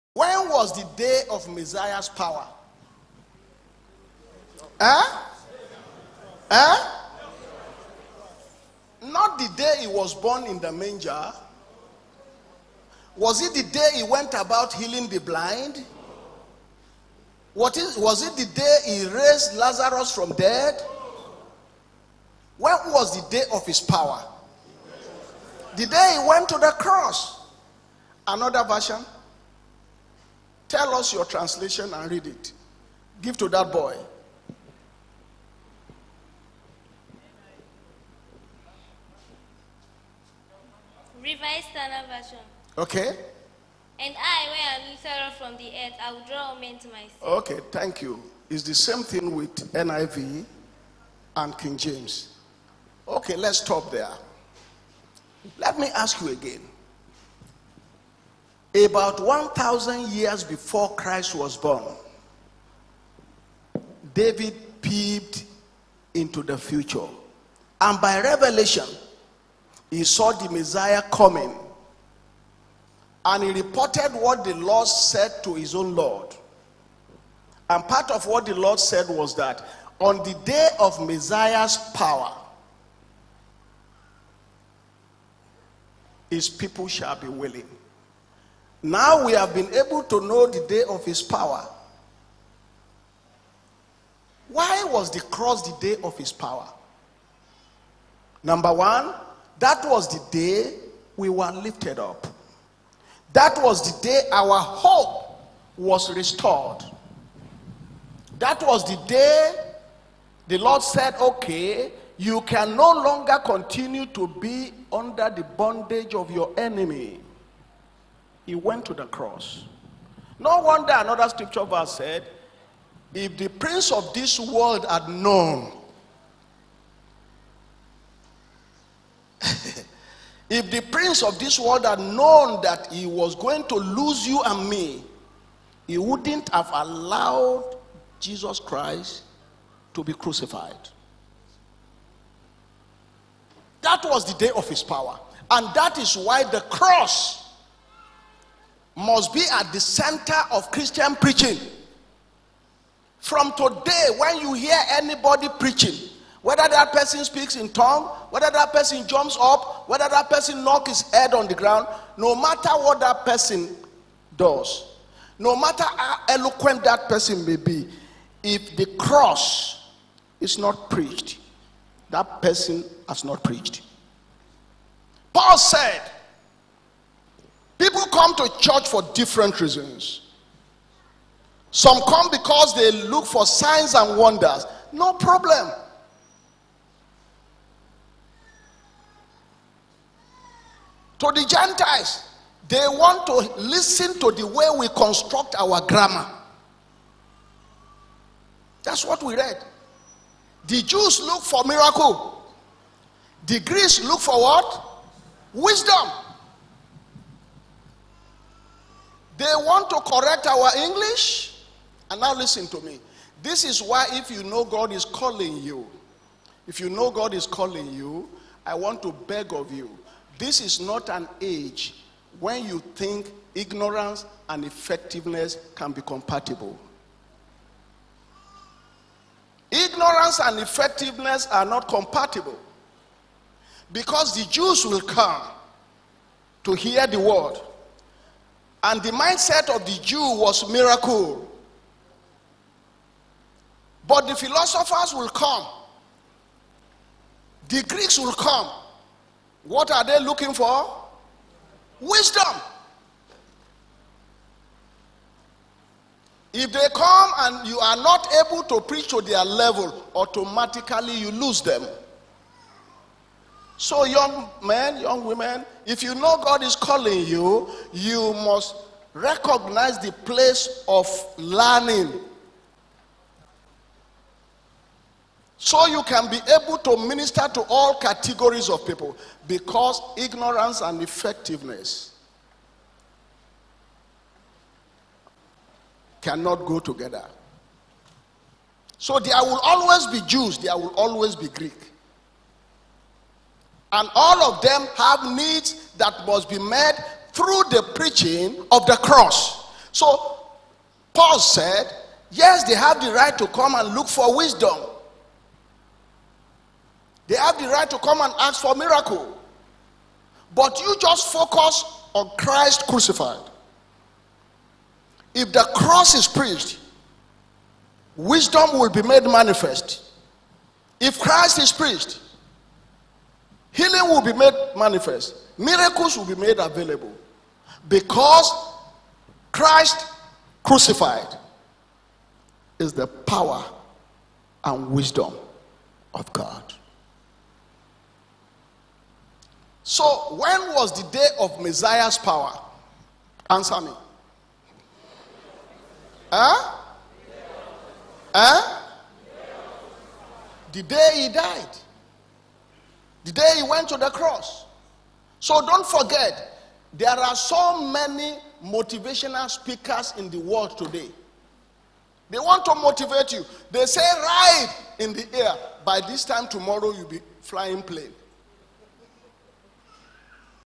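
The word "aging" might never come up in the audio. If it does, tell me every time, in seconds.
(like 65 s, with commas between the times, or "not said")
not said.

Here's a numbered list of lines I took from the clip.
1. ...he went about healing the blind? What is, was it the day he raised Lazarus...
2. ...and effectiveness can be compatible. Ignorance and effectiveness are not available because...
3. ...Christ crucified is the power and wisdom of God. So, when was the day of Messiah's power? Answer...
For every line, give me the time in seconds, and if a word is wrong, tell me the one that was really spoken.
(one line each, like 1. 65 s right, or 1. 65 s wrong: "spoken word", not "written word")
1. 13 s right
2. 224 s wrong: "compatible", not "available"
3. 329 s right.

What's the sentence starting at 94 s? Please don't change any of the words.
Why was the cross the day of his power?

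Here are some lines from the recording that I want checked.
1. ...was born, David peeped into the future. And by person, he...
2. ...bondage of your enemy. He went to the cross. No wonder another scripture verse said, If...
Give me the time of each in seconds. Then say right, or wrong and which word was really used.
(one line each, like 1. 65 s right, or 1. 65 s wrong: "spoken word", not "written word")
1. 61 s wrong: "revelation", not "person"
2. 115 s right.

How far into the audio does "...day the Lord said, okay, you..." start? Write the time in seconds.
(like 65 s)
109 s.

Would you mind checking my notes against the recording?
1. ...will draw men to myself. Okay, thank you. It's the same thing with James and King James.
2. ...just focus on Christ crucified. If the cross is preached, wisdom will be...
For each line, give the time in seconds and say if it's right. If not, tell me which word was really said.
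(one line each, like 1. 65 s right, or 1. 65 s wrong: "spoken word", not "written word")
1. 46 s wrong: "NIV", not "James"
2. 311 s right.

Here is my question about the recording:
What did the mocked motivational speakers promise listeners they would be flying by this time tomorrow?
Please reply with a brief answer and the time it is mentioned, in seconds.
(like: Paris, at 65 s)
plane, at 367 s.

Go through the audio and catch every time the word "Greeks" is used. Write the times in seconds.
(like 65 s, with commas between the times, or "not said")
203 s, 247 s, 291 s.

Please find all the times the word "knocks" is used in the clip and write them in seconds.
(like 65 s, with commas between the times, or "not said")
160 s.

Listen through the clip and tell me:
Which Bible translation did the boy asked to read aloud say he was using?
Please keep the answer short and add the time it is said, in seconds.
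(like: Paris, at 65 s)
Revised Standard Version, at 41 s.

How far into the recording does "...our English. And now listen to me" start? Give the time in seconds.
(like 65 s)
210 s.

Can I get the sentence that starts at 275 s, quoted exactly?
So you can be able to minister to all categories of people because ignorance and effectiveness cannot go together.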